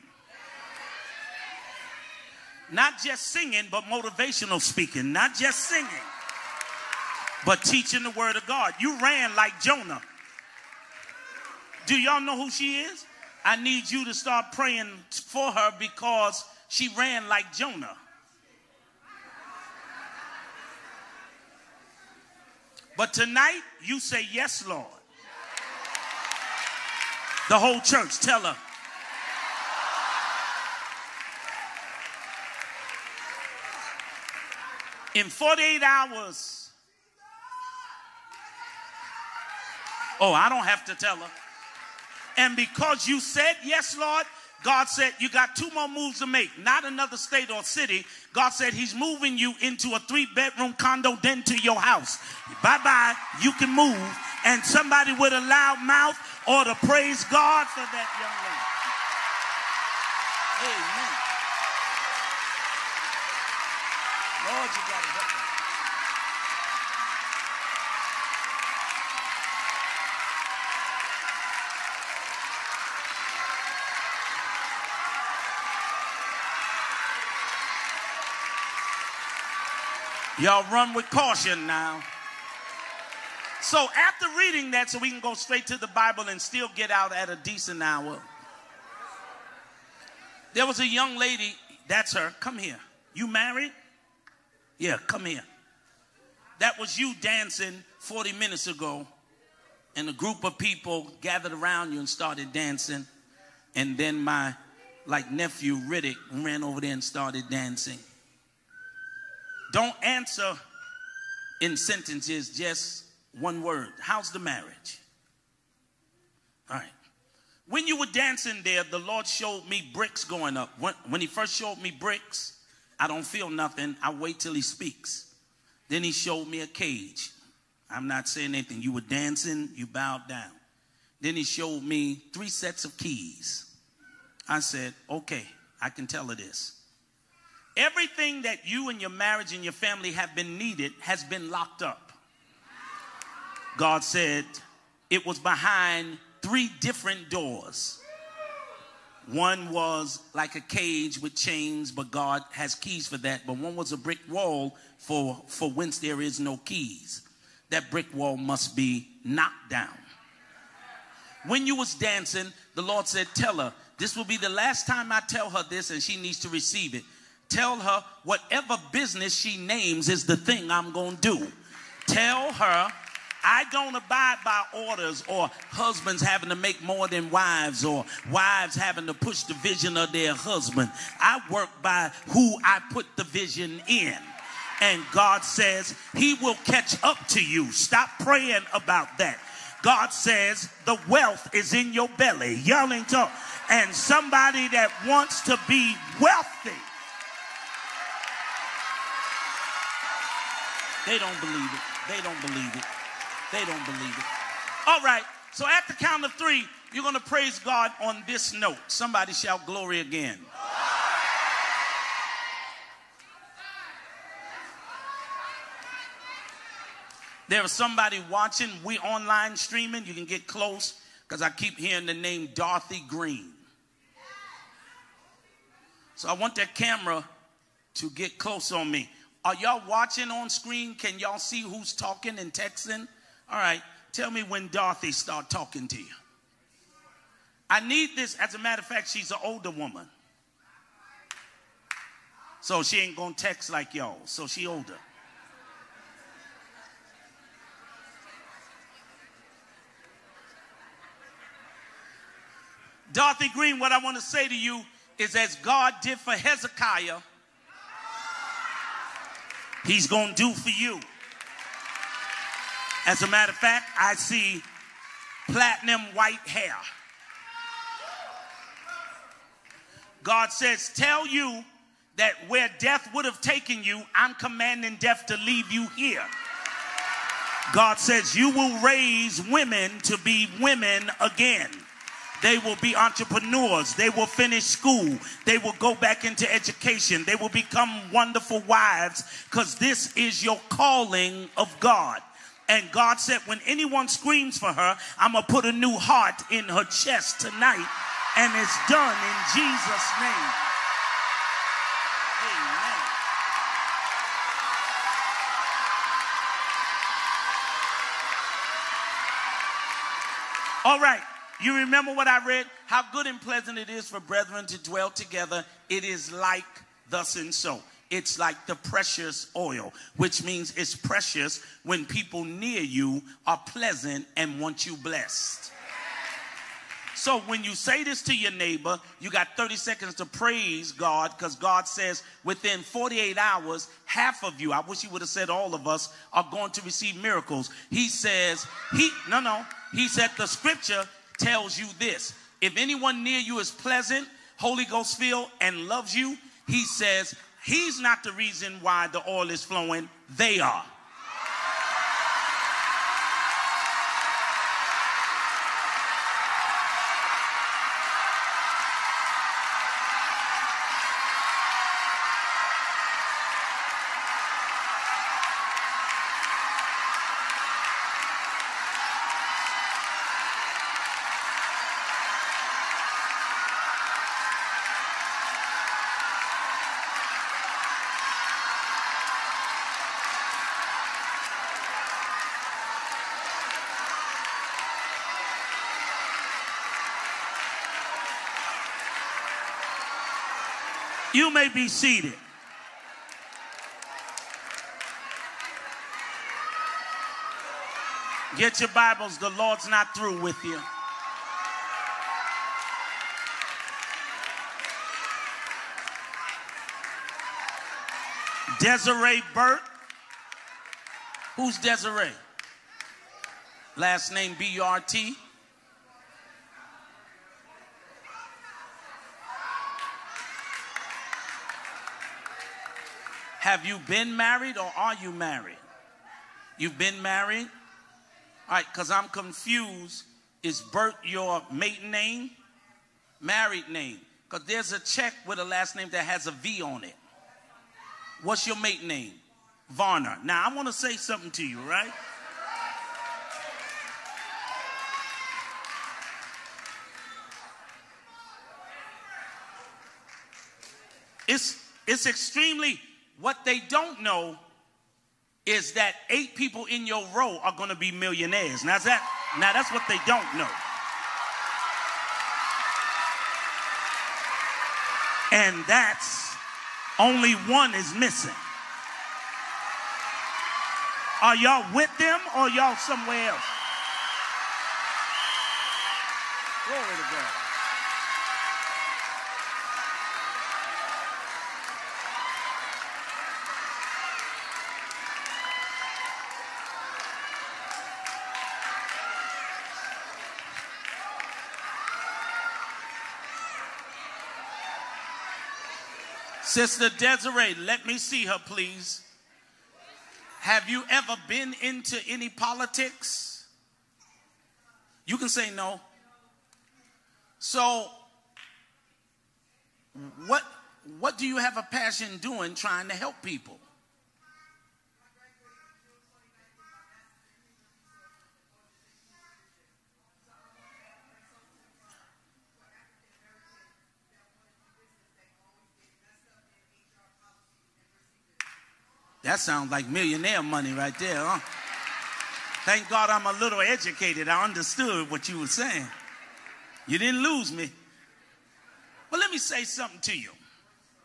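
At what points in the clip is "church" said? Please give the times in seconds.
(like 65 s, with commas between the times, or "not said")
27 s.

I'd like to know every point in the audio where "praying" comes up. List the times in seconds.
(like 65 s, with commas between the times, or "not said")
14 s, 188 s.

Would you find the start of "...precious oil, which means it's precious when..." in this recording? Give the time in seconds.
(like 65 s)
318 s.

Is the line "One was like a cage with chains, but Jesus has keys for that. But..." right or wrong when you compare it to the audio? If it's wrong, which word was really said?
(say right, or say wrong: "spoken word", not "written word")
wrong: "God", not "Jesus".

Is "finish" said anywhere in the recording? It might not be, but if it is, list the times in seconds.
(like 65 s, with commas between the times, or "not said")
284 s.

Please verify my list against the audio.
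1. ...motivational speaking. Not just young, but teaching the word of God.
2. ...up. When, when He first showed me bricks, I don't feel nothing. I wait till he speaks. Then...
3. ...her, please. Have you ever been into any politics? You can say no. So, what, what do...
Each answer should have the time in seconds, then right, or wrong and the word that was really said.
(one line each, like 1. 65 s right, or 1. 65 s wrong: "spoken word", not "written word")
1. 3 s wrong: "singing", not "young"
2. 120 s right
3. 498 s right.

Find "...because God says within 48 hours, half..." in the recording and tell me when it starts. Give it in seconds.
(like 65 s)
331 s.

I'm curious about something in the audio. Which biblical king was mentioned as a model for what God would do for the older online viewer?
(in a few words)
Hezekiah.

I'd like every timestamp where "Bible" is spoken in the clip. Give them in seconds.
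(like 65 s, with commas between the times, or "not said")
85 s, 398 s.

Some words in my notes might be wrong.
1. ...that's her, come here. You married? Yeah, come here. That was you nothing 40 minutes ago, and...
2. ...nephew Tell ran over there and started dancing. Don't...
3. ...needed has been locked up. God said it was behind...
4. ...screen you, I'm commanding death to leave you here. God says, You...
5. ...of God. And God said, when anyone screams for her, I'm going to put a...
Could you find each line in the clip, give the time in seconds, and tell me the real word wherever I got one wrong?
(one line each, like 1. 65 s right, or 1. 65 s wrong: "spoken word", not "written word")
1. 91 s wrong: "dancing", not "nothing"
2. 105 s wrong: "Riddick", not "Tell"
3. 140 s right
4. 273 s wrong: "taken", not "screen"
5. 291 s right.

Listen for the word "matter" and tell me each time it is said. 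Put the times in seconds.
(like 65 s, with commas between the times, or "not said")
238 s, 263 s.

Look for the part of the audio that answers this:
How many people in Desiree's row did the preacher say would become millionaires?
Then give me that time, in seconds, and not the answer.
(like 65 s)
456 s.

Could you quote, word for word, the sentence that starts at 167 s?
Tell her whatever business she names is the thing I'm going to do.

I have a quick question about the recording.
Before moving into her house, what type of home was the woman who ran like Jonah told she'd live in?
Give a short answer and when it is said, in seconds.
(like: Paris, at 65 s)
three bedroom condo, at 50 s.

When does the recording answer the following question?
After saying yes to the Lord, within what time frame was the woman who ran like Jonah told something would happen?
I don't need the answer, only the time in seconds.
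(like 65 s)
35 s.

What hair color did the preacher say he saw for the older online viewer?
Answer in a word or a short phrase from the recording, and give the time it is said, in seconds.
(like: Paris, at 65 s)
platinum white, at 265 s.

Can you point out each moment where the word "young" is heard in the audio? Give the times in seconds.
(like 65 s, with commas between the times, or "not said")
60 s, 90 s.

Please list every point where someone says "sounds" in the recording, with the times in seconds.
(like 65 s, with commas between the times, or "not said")
529 s.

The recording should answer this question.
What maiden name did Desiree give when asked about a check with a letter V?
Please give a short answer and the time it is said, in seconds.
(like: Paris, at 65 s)
Varner, at 439 s.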